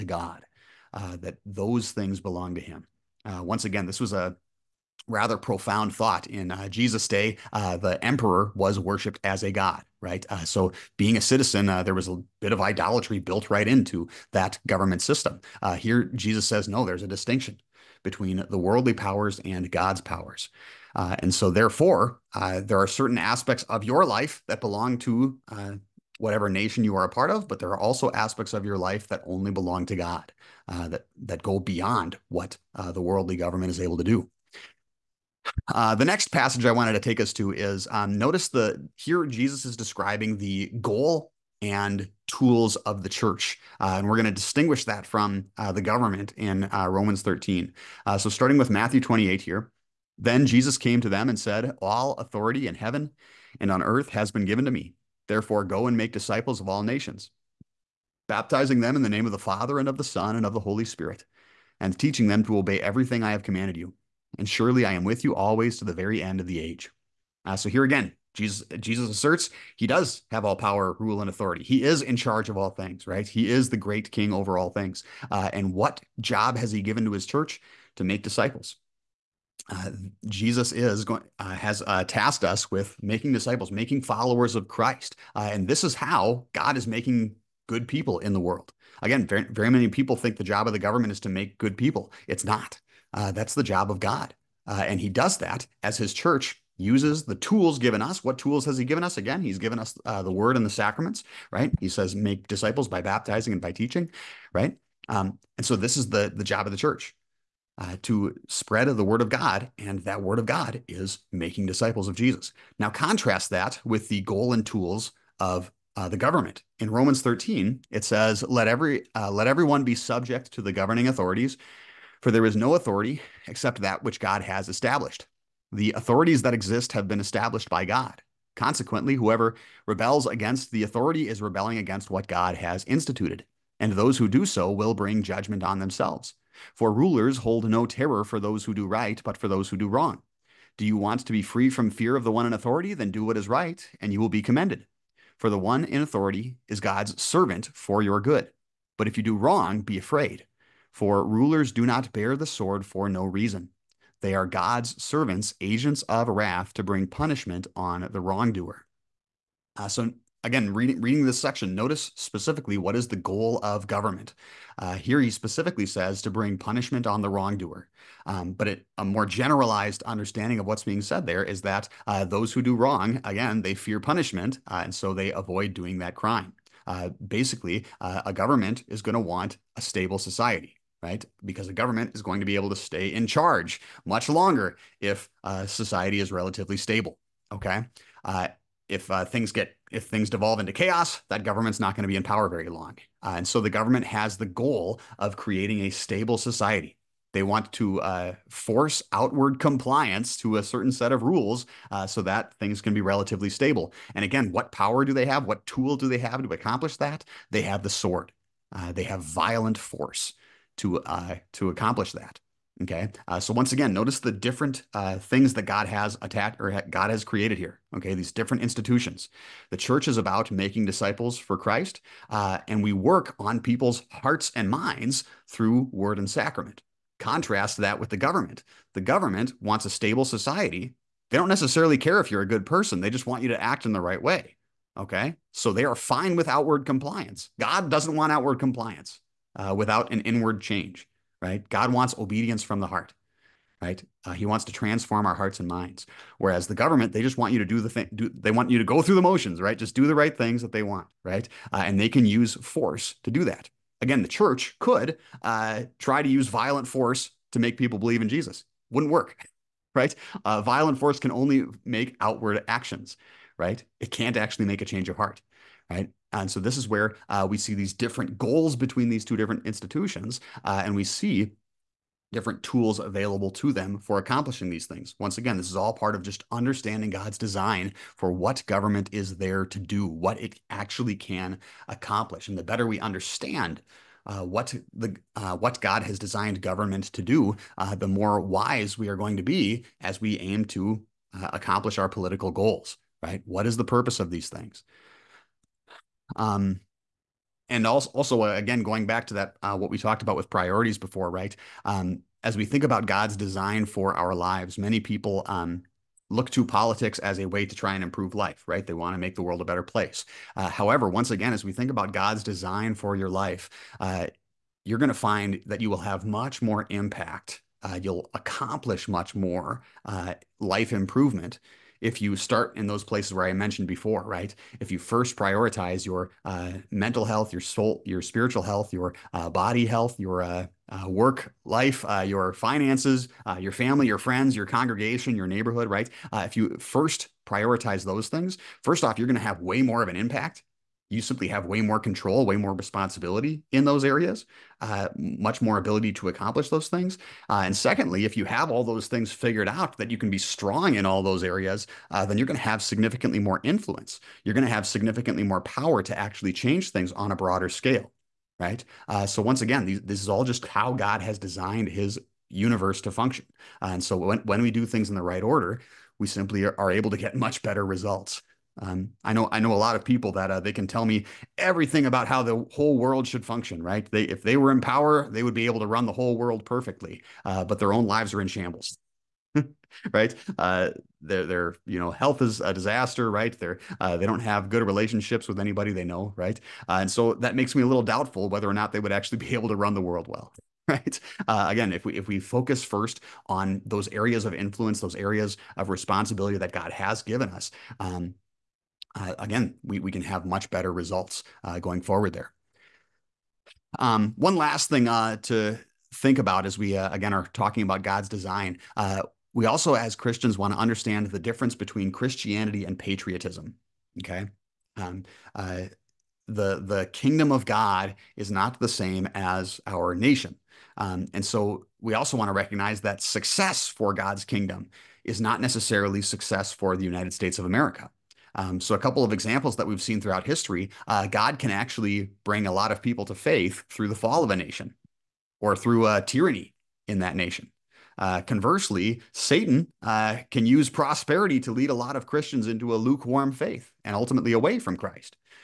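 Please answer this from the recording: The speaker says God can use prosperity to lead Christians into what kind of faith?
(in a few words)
Lukewarm faith.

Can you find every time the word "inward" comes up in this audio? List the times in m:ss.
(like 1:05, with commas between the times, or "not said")
4:00.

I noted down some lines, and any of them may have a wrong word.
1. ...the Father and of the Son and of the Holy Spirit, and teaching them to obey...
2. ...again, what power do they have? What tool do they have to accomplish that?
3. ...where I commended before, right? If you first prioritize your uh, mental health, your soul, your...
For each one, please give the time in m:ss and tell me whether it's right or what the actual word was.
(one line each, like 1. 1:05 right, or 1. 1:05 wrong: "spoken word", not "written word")
1. 0:59 right
2. 3:24 right
3. 5:23 wrong: "mentioned", not "commended".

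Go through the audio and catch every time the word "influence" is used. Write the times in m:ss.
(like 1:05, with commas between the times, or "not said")
5:53, 6:34.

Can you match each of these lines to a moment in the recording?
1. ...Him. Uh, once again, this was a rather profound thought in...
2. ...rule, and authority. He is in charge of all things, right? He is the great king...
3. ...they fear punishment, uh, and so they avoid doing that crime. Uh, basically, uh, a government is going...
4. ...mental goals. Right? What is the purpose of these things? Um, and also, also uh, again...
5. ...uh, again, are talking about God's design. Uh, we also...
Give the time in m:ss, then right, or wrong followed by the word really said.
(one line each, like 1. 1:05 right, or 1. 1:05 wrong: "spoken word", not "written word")
1. 0:02 right
2. 1:10 right
3. 2:53 right
4. 4:52 wrong: "political", not "mental"
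5. 6:46 right.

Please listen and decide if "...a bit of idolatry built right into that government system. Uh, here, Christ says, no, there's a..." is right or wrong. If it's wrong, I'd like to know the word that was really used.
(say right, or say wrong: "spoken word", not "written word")
wrong: "Jesus", not "Christ".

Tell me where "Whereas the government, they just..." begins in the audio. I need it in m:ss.
4:06.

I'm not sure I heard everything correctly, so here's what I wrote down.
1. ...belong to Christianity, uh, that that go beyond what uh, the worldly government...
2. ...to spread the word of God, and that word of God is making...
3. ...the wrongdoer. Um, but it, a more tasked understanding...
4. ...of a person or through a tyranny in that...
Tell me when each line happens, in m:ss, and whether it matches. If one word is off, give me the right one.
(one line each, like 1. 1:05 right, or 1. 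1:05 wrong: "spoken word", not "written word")
1. 0:29 wrong: "God", not "Christianity"
2. 1:48 right
3. 2:47 wrong: "generalized", not "tasked"
4. 7:14 wrong: "nation", not "person".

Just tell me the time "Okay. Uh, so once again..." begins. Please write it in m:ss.
3:32.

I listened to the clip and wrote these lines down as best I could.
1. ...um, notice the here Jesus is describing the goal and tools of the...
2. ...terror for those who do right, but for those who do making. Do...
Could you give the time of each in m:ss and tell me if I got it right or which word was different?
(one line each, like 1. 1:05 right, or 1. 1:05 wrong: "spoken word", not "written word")
1. 0:37 right
2. 2:17 wrong: "wrong", not "making".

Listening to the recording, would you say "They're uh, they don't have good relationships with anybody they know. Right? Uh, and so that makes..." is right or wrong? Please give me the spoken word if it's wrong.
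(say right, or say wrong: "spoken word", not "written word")
right.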